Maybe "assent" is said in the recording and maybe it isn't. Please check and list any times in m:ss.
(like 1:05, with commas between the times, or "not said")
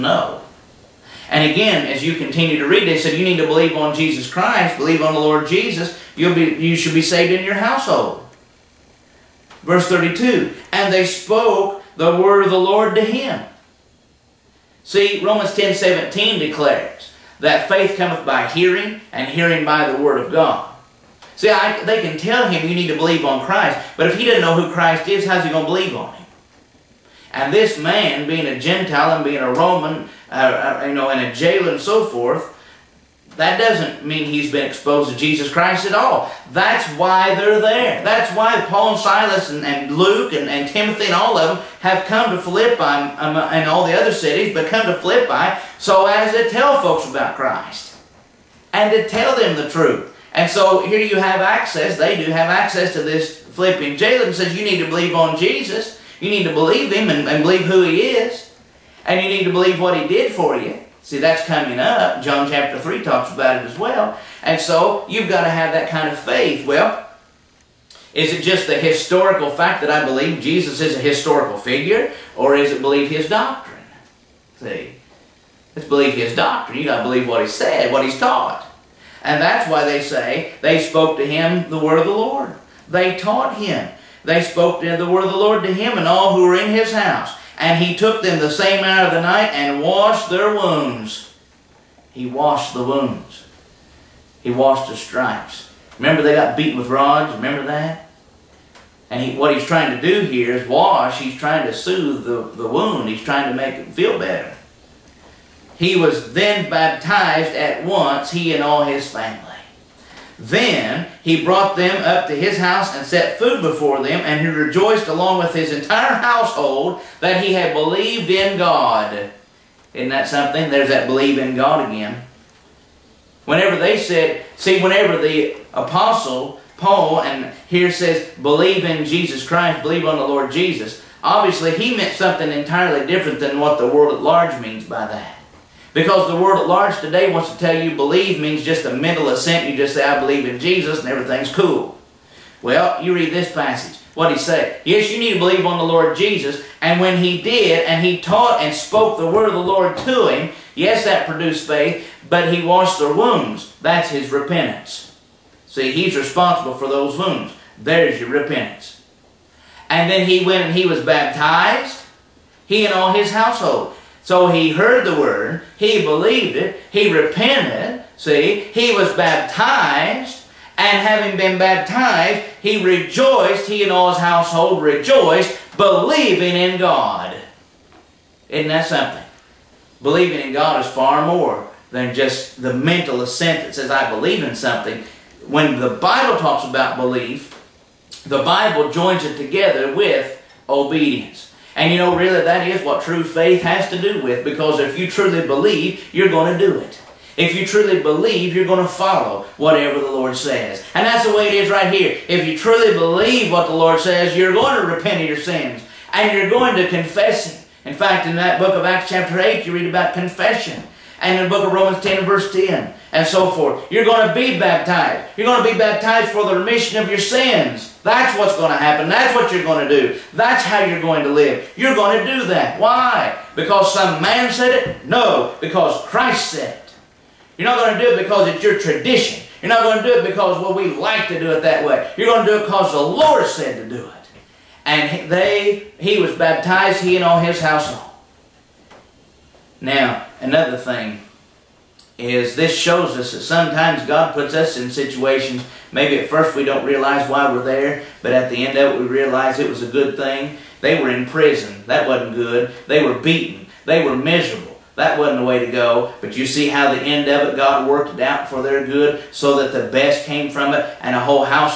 2:19, 3:03.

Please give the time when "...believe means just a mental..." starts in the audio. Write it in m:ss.
2:17.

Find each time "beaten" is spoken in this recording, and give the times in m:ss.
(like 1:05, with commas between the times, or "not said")
1:36, 4:13.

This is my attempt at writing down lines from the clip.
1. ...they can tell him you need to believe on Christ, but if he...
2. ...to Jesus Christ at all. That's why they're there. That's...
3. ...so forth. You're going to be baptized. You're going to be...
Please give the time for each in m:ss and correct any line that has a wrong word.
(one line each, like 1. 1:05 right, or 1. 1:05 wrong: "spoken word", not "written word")
1. 0:21 right
2. 0:35 right
3. 3:33 right.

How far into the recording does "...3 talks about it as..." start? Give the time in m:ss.
1:02.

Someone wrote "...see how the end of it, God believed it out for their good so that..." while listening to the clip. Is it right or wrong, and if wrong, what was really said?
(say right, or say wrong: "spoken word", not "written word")
wrong: "worked", not "believed".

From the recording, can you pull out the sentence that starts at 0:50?
And so here you have access, they do have access to this Philippian jailer and says you need to believe on Jesus.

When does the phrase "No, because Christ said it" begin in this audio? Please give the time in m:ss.
3:45.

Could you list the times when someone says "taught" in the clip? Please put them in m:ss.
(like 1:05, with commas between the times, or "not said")
1:18, 1:23, 2:28.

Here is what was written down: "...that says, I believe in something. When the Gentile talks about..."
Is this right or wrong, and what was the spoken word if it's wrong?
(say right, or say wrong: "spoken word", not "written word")
wrong: "Bible", not "Gentile".